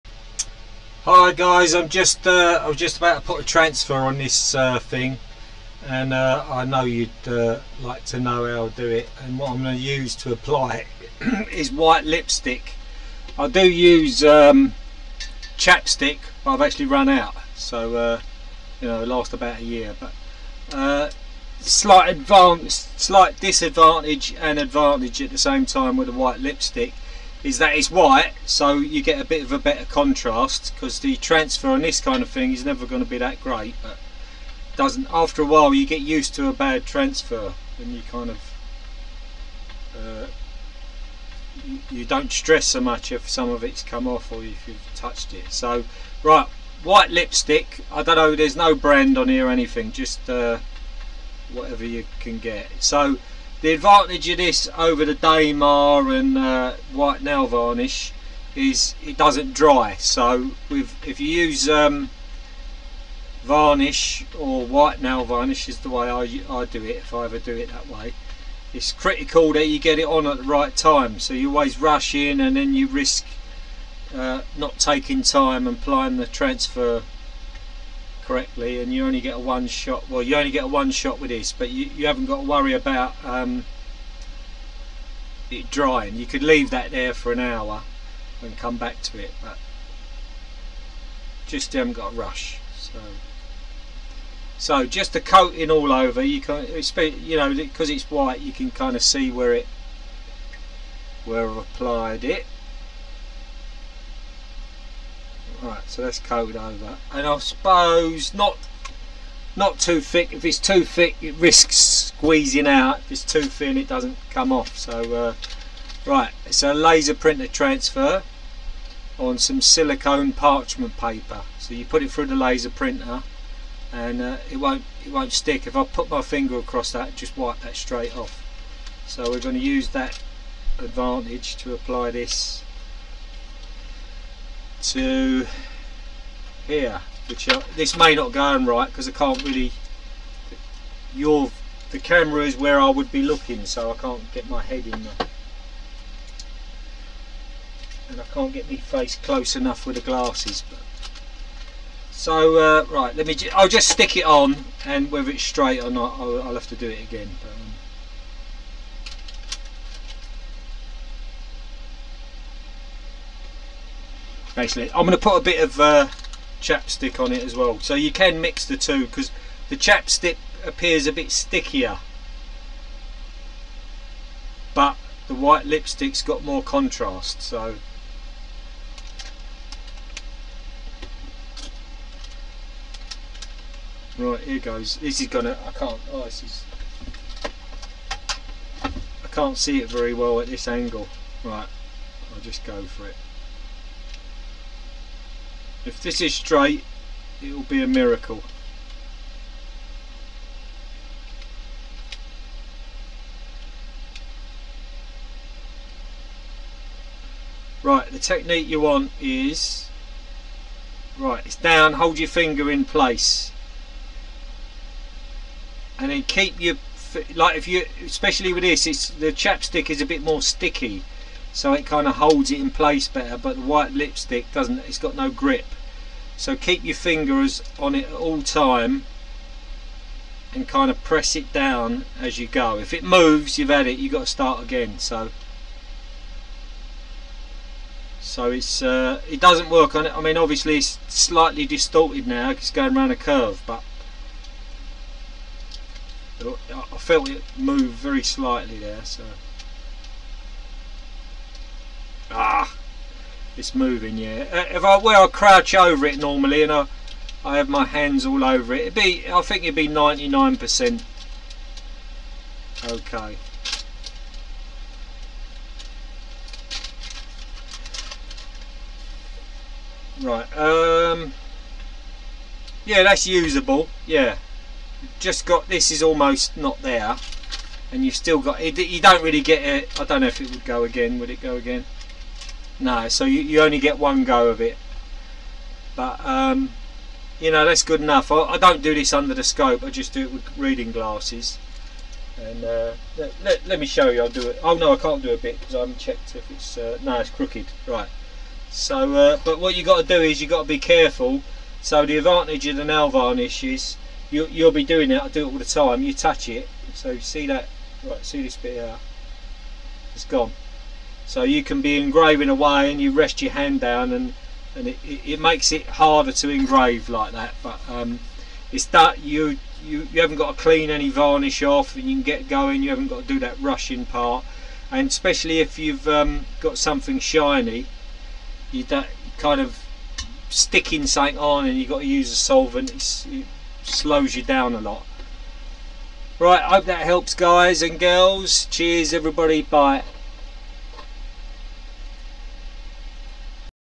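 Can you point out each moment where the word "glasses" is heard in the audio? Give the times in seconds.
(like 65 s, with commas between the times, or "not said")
150 s, 290 s.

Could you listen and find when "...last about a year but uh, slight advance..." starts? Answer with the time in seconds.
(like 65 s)
19 s.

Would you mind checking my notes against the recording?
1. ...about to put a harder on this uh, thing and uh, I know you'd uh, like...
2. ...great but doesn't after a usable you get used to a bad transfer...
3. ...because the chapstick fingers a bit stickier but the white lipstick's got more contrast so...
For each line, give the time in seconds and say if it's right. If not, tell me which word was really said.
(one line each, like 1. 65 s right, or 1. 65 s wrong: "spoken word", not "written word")
1. 2 s wrong: "transfer", not "harder"
2. 33 s wrong: "while", not "usable"
3. 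169 s wrong: "appears", not "fingers".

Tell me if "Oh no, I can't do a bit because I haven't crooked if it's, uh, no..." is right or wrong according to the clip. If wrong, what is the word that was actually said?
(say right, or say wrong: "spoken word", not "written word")
wrong: "checked", not "crooked".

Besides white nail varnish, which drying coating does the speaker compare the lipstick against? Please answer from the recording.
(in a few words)
Dammar.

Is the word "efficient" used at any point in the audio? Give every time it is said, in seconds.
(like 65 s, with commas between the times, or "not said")
not said.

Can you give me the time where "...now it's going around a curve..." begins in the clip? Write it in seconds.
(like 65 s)
242 s.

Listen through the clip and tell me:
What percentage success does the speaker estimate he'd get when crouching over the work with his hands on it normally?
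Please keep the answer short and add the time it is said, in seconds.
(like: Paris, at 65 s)
99%, at 259 s.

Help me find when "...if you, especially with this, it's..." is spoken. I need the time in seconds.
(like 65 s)
217 s.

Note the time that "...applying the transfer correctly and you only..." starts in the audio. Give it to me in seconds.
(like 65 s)
75 s.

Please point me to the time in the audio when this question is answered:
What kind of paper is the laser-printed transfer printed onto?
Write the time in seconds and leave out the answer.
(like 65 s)
119 s.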